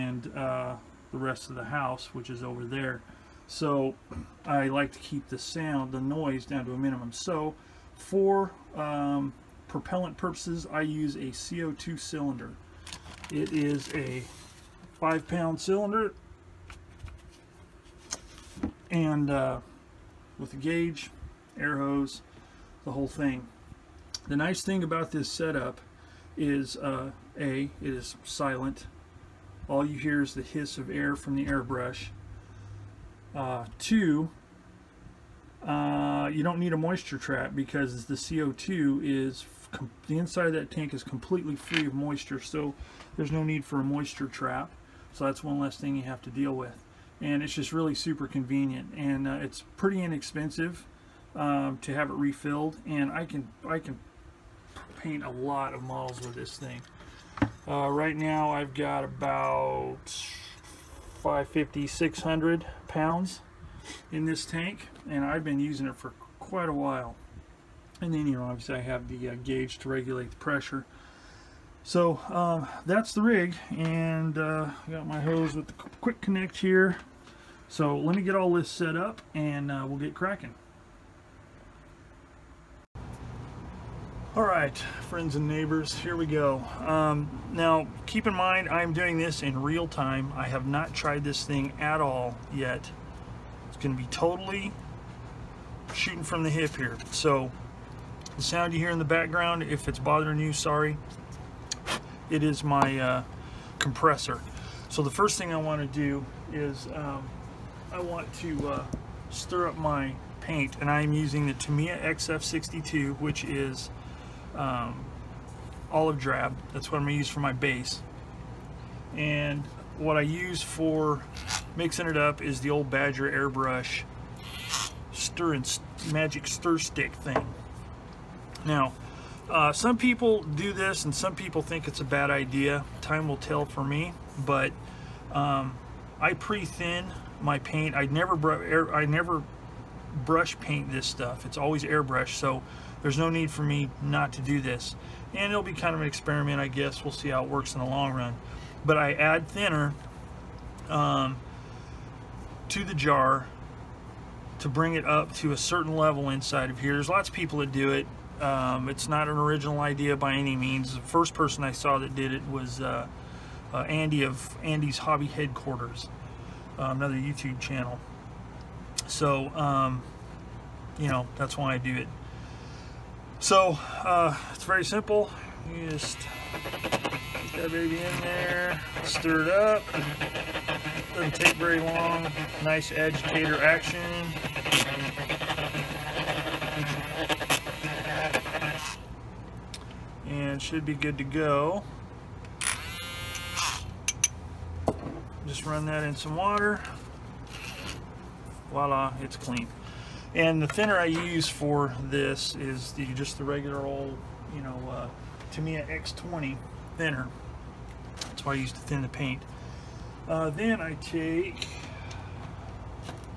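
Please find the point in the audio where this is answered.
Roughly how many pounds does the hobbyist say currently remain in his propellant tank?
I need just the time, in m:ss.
1:01.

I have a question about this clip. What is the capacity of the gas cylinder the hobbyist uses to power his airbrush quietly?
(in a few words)
5 pounds.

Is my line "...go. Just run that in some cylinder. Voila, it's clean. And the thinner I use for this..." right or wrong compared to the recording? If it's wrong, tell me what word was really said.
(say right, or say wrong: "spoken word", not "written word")
wrong: "water", not "cylinder".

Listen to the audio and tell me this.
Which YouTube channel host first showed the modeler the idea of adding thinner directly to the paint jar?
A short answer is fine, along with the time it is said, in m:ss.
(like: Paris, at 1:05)
Andy's Hobby Headquarters, at 2:43.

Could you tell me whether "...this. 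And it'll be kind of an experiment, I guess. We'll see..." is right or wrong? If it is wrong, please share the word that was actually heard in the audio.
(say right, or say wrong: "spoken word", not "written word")
right.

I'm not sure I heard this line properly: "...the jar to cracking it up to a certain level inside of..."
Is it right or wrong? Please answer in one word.
wrong.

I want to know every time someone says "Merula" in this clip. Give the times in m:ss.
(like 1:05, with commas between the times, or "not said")
not said.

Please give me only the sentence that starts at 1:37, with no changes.
So the sound you hear in the background, if it's bothering you, sorry, it is my uh, compressor.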